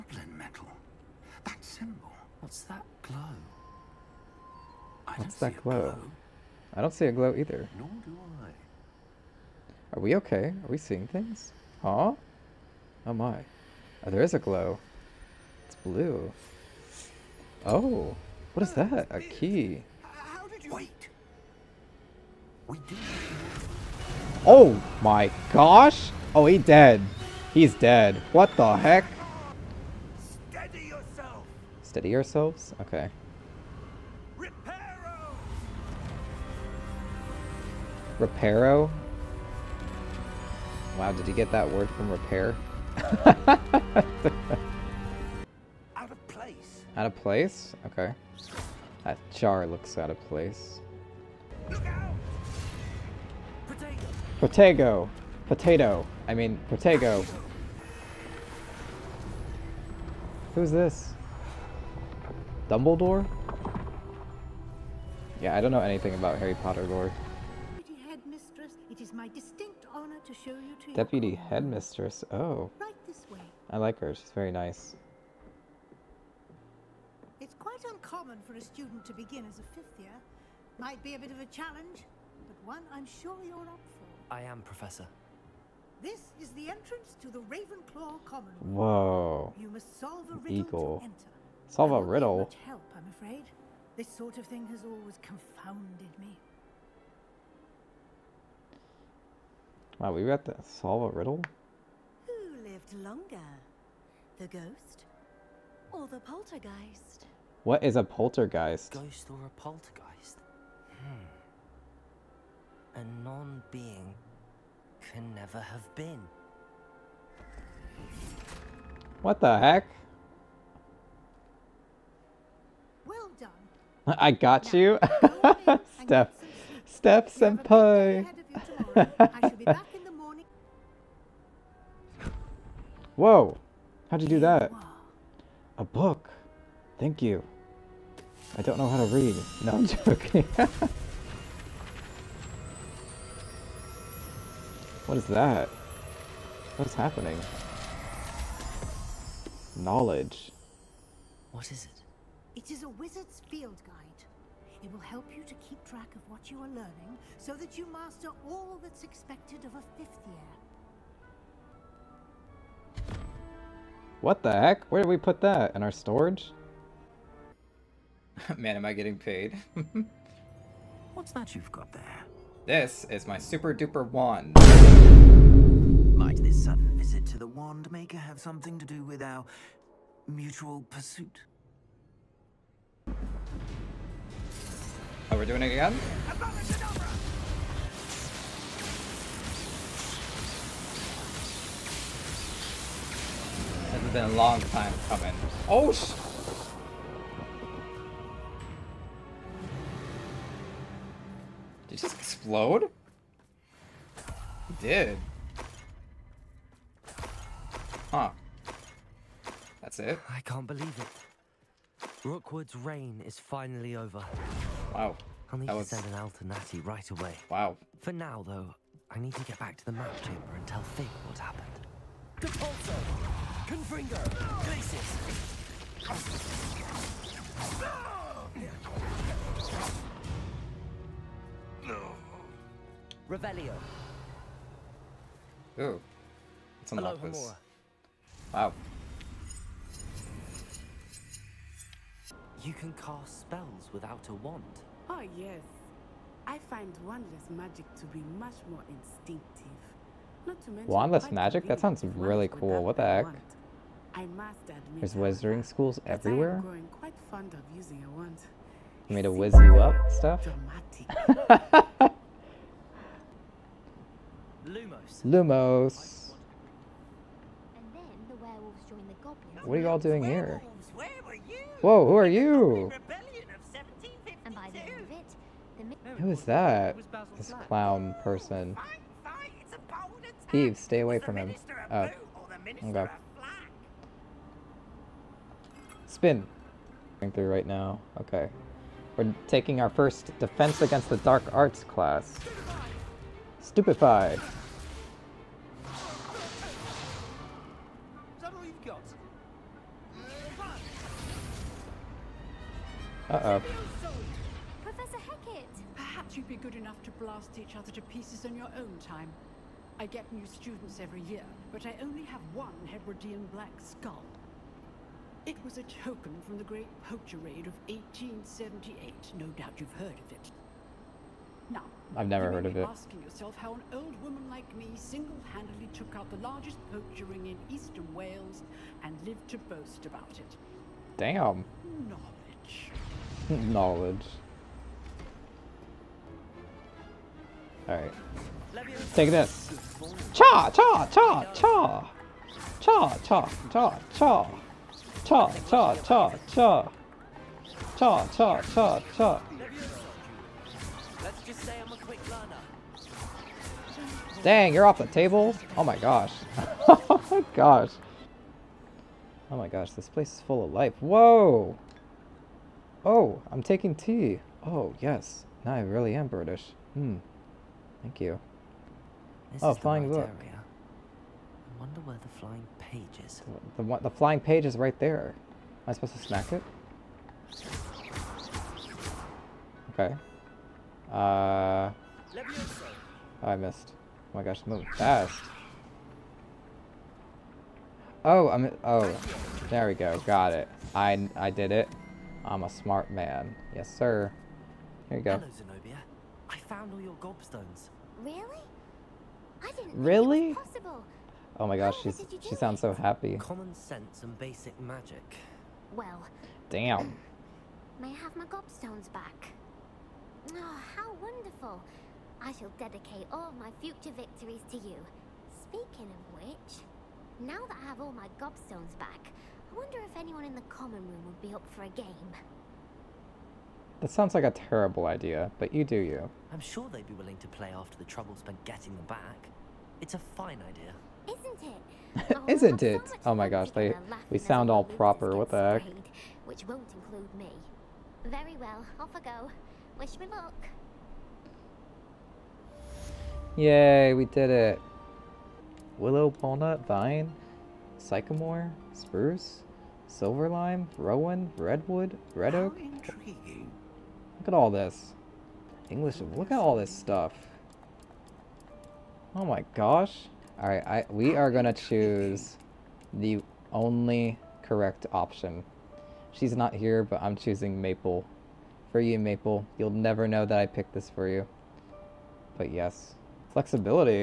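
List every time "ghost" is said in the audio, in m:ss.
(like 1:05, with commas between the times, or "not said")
1:44, 1:48.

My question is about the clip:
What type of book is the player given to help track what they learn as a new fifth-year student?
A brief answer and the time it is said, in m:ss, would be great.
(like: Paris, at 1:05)
wizard's field guide, at 2:32.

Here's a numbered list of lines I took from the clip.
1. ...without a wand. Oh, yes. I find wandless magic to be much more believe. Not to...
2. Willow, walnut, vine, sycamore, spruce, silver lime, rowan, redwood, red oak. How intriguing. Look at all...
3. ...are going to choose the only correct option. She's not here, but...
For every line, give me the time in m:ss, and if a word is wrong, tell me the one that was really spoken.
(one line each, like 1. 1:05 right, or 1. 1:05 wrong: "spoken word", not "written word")
1. 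4:03 wrong: "instinctive", not "believe"
2. 7:25 right
3. 7:41 right.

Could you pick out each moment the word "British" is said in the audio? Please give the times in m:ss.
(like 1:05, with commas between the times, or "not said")
6:06.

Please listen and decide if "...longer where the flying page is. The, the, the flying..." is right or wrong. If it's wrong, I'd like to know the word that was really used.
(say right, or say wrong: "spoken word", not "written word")
wrong: "wonder", not "longer".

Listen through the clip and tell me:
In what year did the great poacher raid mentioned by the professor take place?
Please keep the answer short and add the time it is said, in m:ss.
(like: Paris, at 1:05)
1878, at 5:17.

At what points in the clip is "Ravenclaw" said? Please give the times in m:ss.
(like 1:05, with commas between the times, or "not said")
1:27.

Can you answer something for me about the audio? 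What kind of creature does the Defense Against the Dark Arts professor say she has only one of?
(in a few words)
Hebridean black skull.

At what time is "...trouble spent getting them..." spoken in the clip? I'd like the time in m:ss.
7:08.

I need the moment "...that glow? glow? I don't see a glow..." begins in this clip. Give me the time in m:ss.
0:05.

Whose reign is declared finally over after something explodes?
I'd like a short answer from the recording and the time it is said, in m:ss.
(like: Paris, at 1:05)
Rookwood, at 3:32.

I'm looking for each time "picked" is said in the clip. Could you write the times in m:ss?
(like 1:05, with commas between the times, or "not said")
7:50.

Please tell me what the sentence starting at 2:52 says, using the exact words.
This is my super duper wand.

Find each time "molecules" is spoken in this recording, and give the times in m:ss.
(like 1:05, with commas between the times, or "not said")
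not said.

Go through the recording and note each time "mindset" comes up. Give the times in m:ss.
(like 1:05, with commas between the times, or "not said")
not said.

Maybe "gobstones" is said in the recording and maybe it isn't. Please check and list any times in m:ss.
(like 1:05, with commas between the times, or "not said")
6:37, 6:48, 6:58.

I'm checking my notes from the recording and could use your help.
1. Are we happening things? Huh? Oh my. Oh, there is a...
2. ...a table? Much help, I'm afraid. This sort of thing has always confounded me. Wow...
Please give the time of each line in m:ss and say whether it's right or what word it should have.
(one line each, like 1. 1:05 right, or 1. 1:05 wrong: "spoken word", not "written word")
1. 0:10 wrong: "seeing", not "happening"
2. 1:31 wrong: "riddle", not "table".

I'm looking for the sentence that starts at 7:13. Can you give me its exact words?
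So oh my gosh, they we sound all proper.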